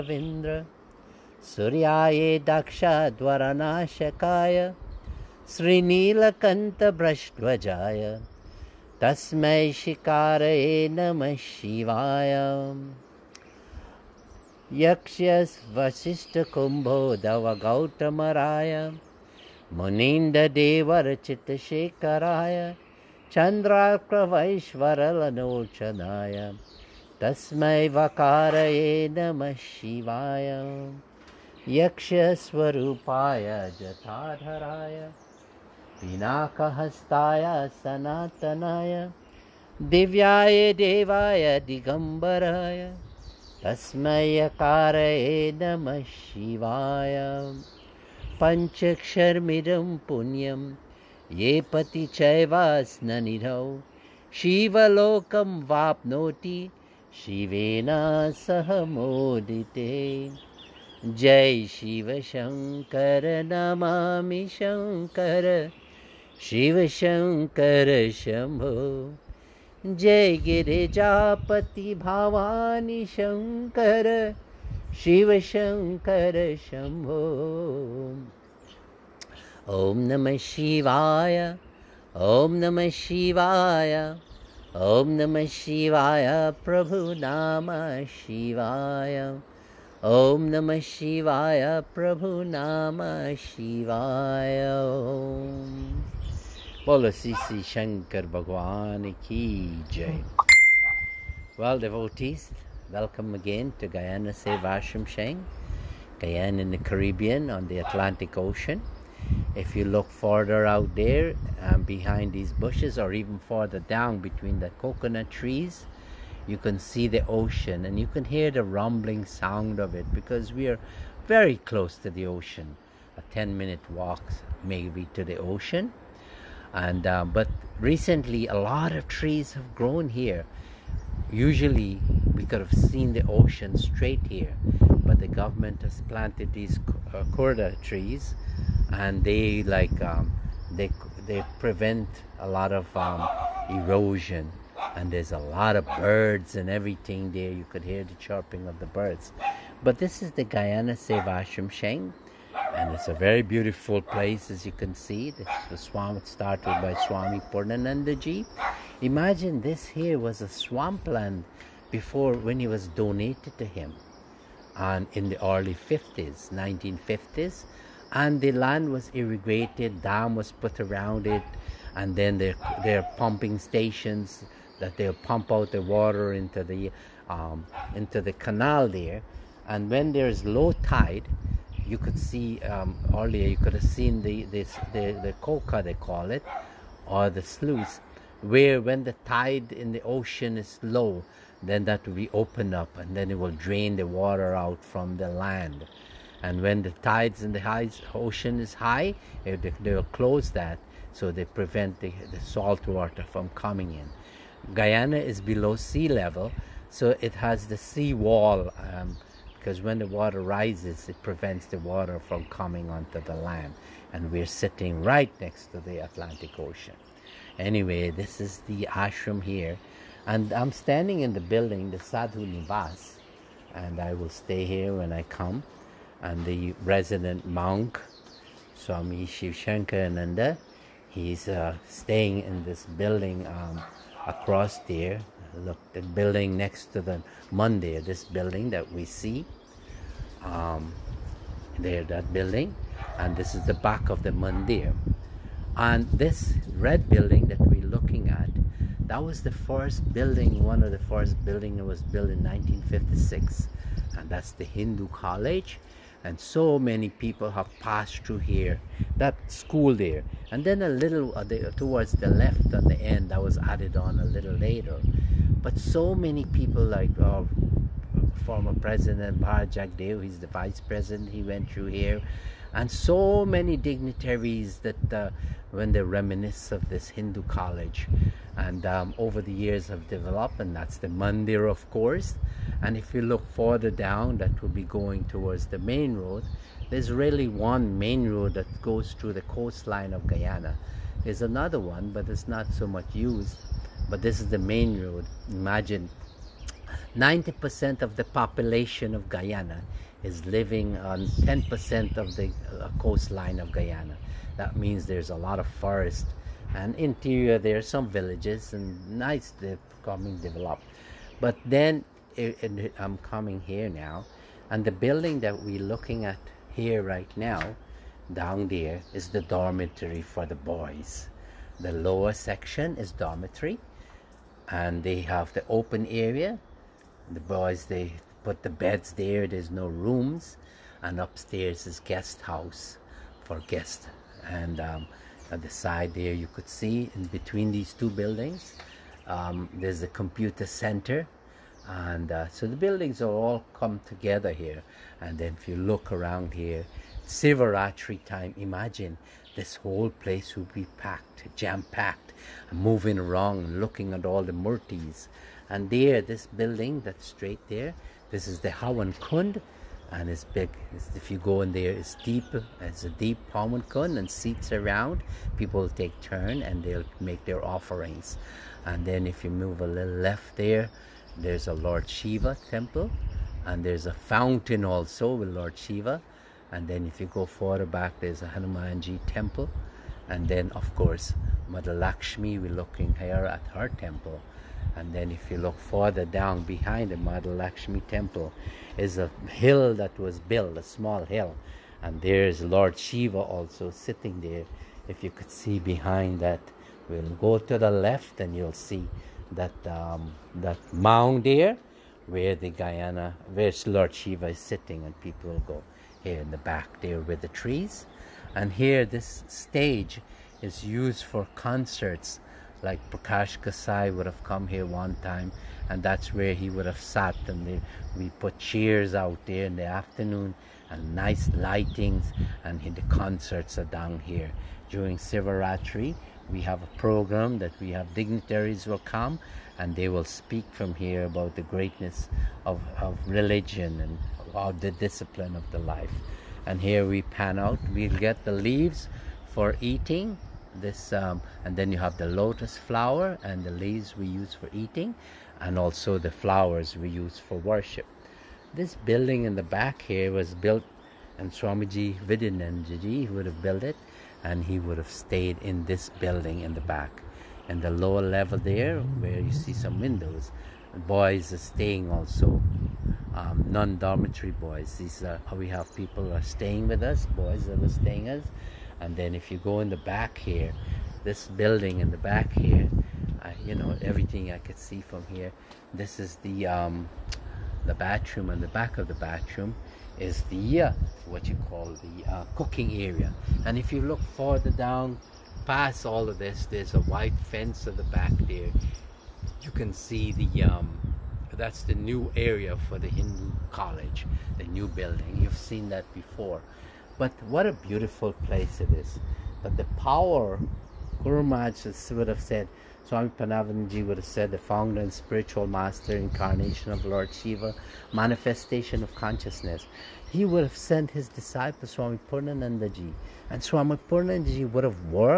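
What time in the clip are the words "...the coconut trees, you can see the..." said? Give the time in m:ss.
1:54.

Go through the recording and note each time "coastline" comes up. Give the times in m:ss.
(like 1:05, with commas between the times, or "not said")
4:49, 5:02.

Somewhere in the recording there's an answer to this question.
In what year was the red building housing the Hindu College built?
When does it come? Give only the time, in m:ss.
4:12.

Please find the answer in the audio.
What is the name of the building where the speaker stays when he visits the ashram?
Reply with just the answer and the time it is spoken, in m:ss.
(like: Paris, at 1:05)
Sadhu Nivas, at 3:41.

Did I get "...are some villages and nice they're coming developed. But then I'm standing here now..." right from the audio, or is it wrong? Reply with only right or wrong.
wrong.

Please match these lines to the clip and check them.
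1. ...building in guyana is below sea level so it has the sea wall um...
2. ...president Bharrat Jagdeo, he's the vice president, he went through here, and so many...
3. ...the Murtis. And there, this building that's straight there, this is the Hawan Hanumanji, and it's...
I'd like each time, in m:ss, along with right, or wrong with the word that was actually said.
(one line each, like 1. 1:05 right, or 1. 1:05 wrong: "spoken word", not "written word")
1. 3:23 wrong: "coming", not "building"
2. 4:28 right
3. 5:54 wrong: "Kund", not "Hanumanji".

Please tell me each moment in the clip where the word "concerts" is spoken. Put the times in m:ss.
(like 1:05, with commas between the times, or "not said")
6:51, 7:03.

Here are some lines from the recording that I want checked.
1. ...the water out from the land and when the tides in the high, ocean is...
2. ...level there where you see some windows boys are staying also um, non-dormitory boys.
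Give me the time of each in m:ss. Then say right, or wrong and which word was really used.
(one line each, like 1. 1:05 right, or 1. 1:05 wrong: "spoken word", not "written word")
1. 3:13 right
2. 7:38 right.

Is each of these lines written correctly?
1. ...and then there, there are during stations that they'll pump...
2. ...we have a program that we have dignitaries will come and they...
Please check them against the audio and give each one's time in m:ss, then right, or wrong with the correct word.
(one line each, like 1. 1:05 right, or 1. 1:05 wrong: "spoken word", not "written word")
1. 2:51 wrong: "pumping", not "during"
2. 7:06 right.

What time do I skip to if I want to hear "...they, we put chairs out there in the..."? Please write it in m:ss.
6:57.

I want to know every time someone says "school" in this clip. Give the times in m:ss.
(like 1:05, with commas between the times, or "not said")
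4:19.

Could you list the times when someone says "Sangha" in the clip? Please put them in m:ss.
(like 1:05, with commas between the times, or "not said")
1:45, 2:31.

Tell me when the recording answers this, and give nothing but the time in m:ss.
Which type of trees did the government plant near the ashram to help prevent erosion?
2:17.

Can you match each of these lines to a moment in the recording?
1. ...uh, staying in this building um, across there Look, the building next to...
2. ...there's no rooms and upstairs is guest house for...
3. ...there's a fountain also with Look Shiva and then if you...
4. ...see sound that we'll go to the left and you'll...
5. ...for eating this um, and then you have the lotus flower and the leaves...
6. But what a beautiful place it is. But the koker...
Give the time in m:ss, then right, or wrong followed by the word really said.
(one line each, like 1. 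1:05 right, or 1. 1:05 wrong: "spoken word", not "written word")
1. 3:51 right
2. 5:29 right
3. 6:13 wrong: "Lord", not "Look"
4. 6:35 wrong: "behind", not "sound"
5. 7:19 right
6. 8:17 wrong: "power", not "koker".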